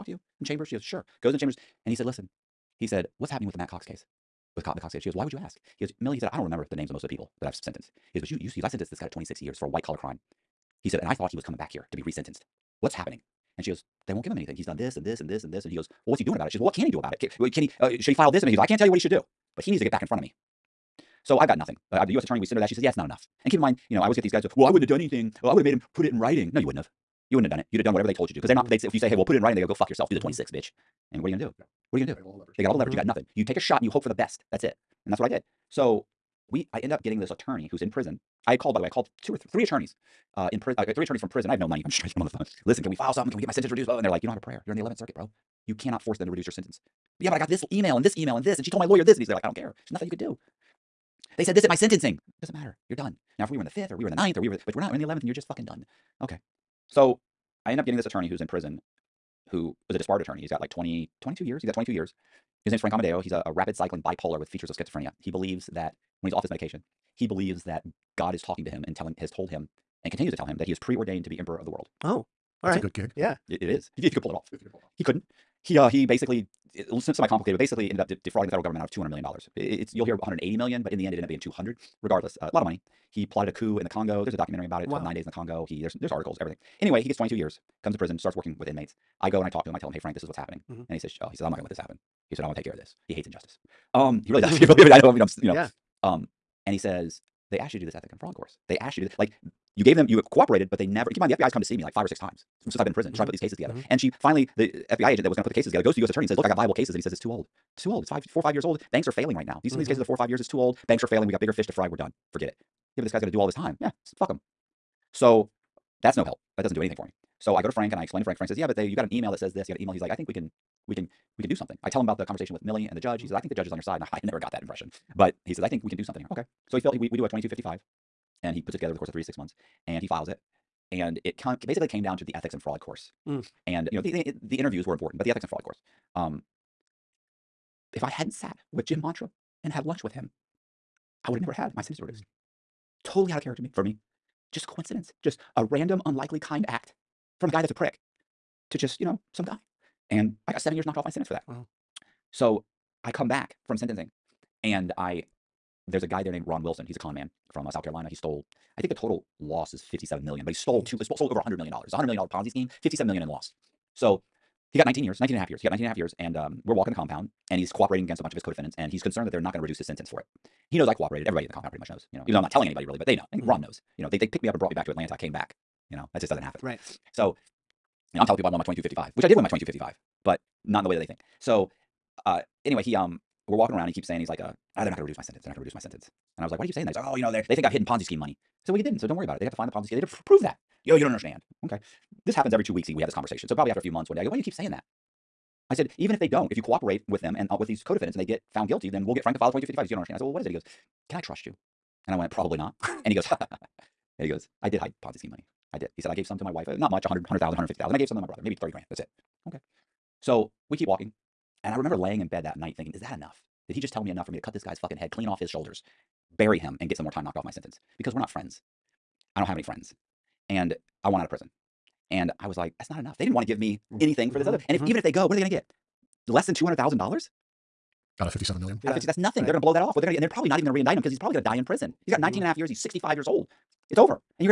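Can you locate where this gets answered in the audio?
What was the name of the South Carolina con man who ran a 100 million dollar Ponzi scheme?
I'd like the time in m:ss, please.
2:36.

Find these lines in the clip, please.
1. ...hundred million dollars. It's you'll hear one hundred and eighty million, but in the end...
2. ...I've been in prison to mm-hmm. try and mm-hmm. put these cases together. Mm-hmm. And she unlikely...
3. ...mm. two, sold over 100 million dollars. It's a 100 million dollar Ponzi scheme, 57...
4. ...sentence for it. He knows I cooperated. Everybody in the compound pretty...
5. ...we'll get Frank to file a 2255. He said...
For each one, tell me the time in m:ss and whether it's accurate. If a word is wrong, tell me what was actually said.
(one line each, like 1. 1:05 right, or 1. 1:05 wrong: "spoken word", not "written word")
1. 1:19 right
2. 1:42 wrong: "finally", not "unlikely"
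3. 2:40 right
4. 2:49 right
5. 3:19 right.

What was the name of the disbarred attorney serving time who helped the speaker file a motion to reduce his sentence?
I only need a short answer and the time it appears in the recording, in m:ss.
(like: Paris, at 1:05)
Frank Amodeo, at 1:02.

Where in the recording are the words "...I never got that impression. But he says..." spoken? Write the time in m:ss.
2:04.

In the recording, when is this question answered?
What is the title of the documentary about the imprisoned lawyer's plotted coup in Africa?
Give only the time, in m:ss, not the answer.
1:25.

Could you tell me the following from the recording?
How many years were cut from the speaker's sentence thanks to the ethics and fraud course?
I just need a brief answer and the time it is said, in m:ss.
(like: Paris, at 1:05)
7, at 2:30.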